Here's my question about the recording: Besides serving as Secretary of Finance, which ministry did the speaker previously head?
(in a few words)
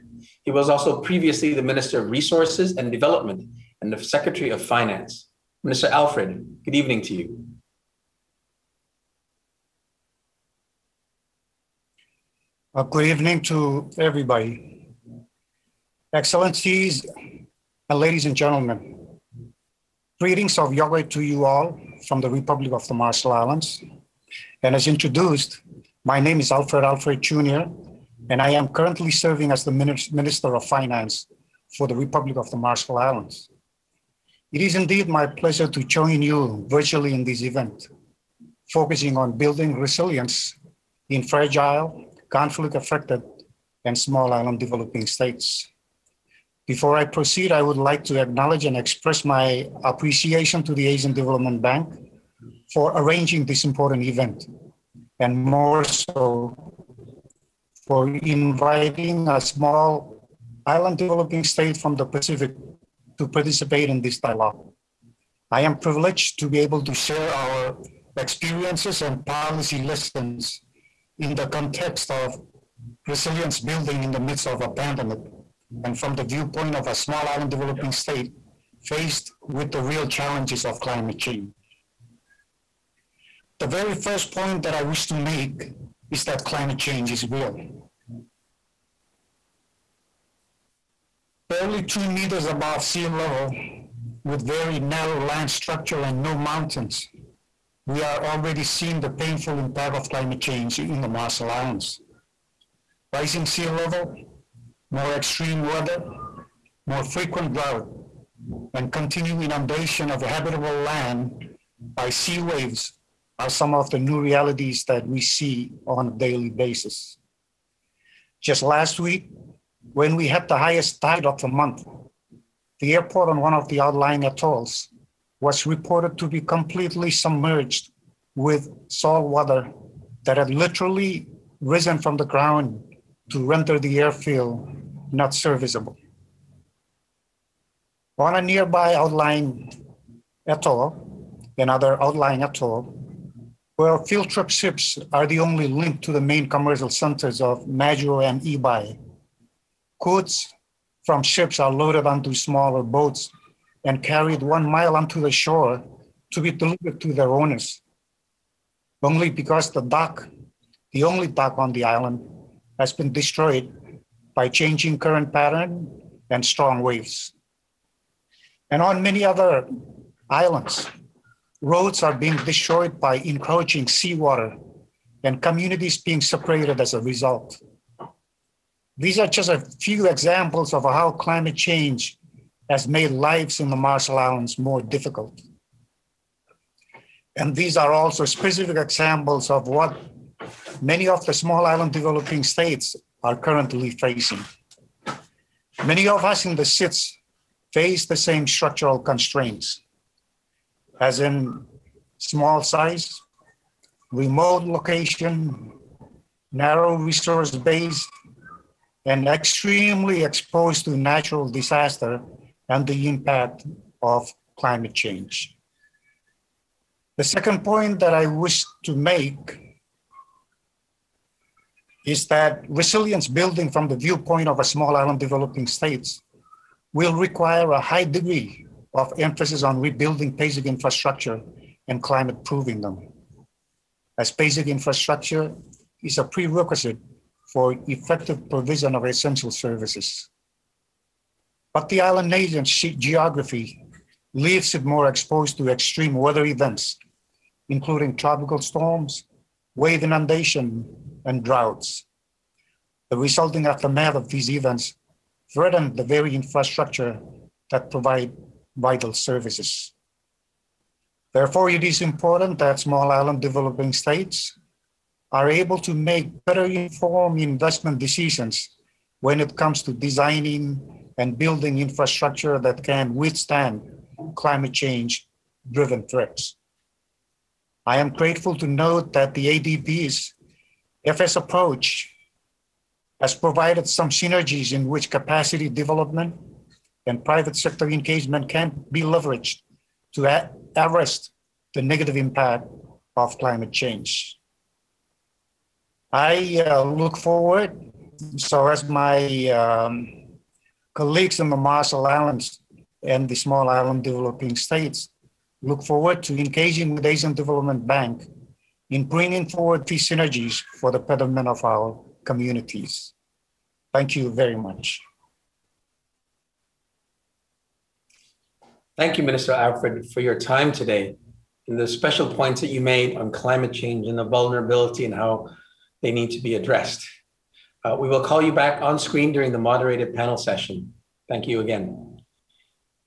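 Resources and Development.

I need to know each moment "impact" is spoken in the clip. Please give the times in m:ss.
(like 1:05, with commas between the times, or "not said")
1:39, 3:33, 4:52.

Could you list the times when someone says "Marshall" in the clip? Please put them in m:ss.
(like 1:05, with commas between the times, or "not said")
0:22, 0:32, 1:41, 3:03, 5:01.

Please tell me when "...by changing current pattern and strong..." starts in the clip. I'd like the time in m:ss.
2:44.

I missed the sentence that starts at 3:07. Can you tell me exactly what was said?
And these are also specific examples of what many of the small island developing states are currently facing.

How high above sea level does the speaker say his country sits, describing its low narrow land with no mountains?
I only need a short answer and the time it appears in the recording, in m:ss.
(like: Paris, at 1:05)
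2 meters, at 1:31.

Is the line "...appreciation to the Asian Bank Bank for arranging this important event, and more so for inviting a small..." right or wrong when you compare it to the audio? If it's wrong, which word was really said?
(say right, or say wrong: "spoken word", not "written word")
wrong: "Development", not "Bank".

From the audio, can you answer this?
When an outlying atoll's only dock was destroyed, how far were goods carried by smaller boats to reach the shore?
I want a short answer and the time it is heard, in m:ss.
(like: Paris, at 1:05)
1 mile, at 2:34.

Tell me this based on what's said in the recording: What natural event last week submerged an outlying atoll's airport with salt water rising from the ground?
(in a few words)
highest tide of the month.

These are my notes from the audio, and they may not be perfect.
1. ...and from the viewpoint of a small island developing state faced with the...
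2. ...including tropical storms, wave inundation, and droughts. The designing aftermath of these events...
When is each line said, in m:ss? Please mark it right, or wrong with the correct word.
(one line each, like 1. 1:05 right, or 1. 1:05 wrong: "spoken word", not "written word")
1. 1:15 right
2. 4:07 wrong: "resulting", not "designing".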